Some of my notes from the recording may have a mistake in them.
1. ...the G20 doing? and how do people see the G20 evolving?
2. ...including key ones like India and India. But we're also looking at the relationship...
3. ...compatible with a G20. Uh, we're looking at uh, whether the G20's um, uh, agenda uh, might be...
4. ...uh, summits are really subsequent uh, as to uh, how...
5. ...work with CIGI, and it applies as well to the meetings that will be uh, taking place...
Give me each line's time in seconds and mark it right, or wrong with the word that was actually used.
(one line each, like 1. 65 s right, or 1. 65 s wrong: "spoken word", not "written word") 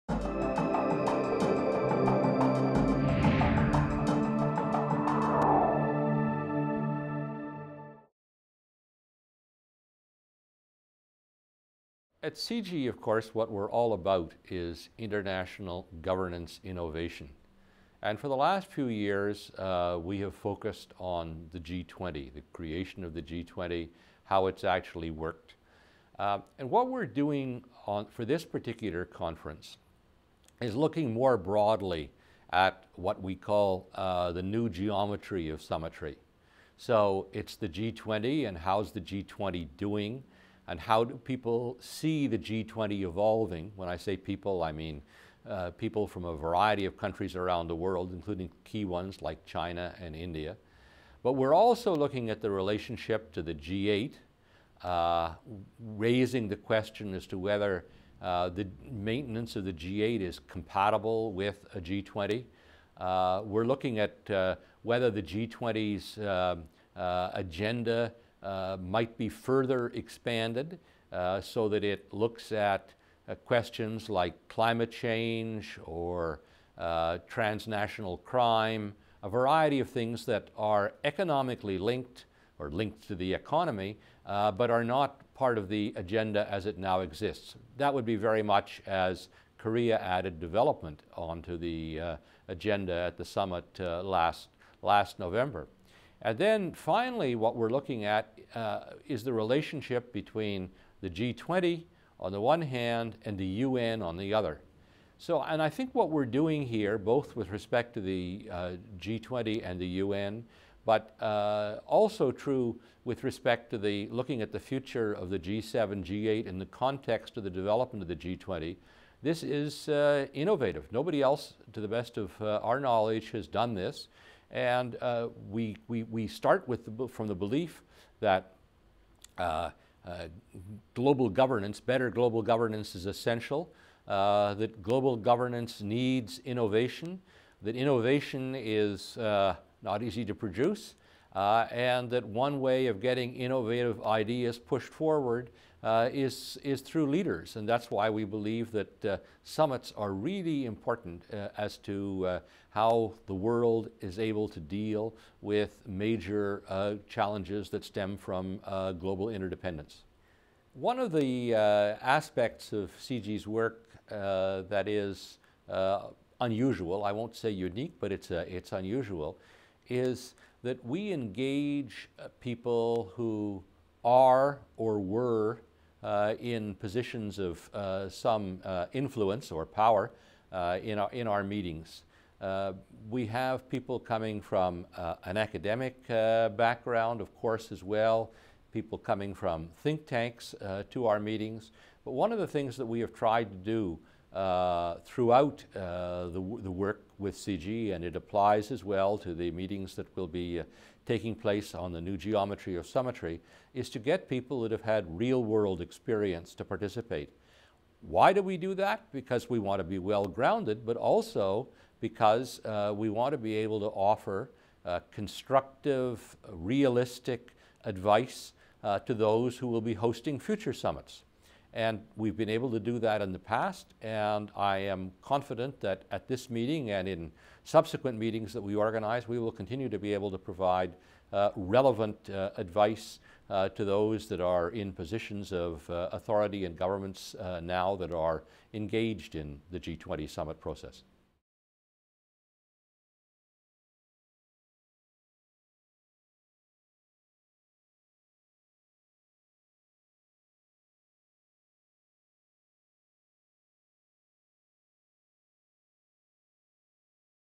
1. 38 s right
2. 48 s wrong: "China", not "India"
3. 60 s right
4. 149 s wrong: "important", not "subsequent"
5. 196 s right.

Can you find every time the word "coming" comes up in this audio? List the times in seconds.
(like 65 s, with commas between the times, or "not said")
183 s, 188 s.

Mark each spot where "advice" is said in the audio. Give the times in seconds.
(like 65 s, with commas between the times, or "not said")
217 s, 232 s.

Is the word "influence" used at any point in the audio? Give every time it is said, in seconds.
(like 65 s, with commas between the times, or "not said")
178 s.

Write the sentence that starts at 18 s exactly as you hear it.
And for the last few years, uh, we have focused on the G20, the creation of the G20, how it's actually worked.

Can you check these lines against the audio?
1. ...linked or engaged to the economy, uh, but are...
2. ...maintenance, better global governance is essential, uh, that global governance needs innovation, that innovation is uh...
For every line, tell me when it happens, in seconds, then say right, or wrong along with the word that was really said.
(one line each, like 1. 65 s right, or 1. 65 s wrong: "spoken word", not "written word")
1. 81 s wrong: "linked", not "engaged"
2. 131 s wrong: "governance", not "maintenance".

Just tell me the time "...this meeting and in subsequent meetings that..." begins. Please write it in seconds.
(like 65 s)
226 s.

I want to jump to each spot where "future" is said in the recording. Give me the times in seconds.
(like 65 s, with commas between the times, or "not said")
114 s, 220 s.